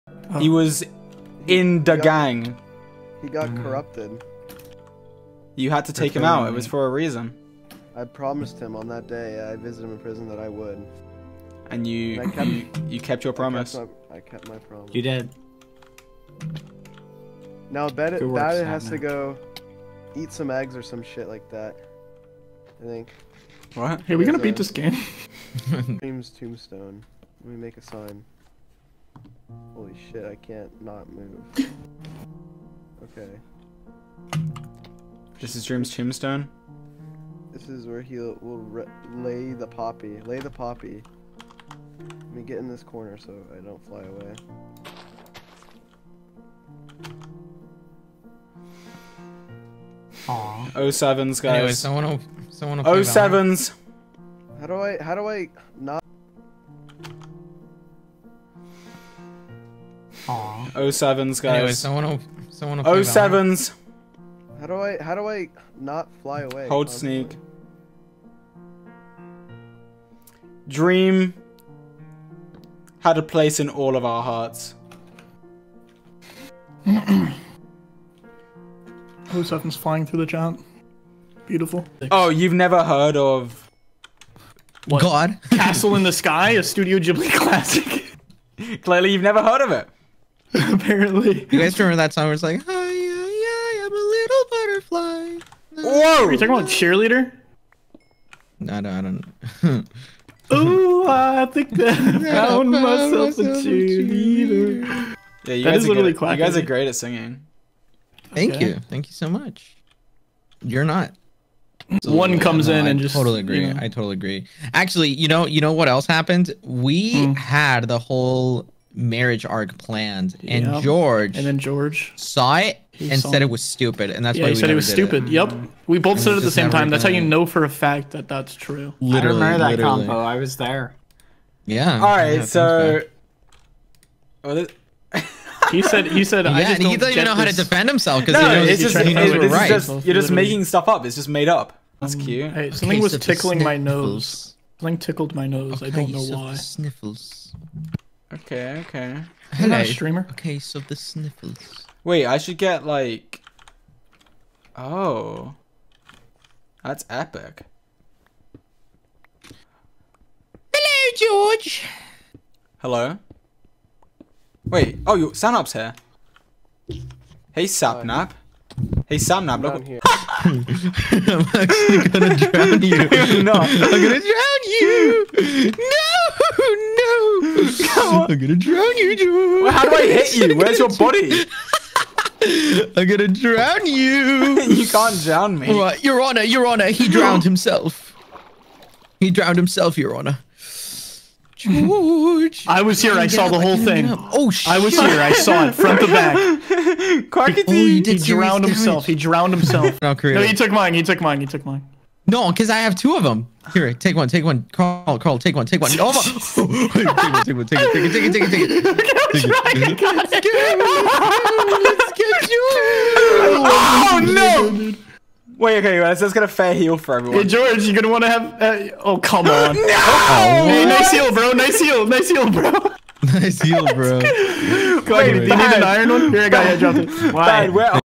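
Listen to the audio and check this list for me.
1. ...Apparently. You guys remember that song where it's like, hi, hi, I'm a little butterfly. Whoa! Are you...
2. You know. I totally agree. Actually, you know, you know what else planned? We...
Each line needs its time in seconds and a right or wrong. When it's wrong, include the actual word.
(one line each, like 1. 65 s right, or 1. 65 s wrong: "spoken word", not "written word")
1. 90 s right
2. 113 s wrong: "happened", not "planned".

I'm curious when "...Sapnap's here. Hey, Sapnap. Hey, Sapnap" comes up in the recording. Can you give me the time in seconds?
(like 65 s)
165 s.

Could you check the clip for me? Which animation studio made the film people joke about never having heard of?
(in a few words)
Studio Ghibli.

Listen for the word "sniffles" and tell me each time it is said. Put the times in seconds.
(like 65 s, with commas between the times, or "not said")
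146 s, 150 s.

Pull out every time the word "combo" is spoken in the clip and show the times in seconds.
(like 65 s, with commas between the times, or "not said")
130 s.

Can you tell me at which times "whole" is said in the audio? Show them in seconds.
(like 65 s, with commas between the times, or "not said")
117 s, 193 s.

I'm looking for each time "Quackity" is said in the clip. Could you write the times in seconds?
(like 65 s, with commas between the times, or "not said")
197 s.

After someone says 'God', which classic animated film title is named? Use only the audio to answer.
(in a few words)
Castle in the Sky.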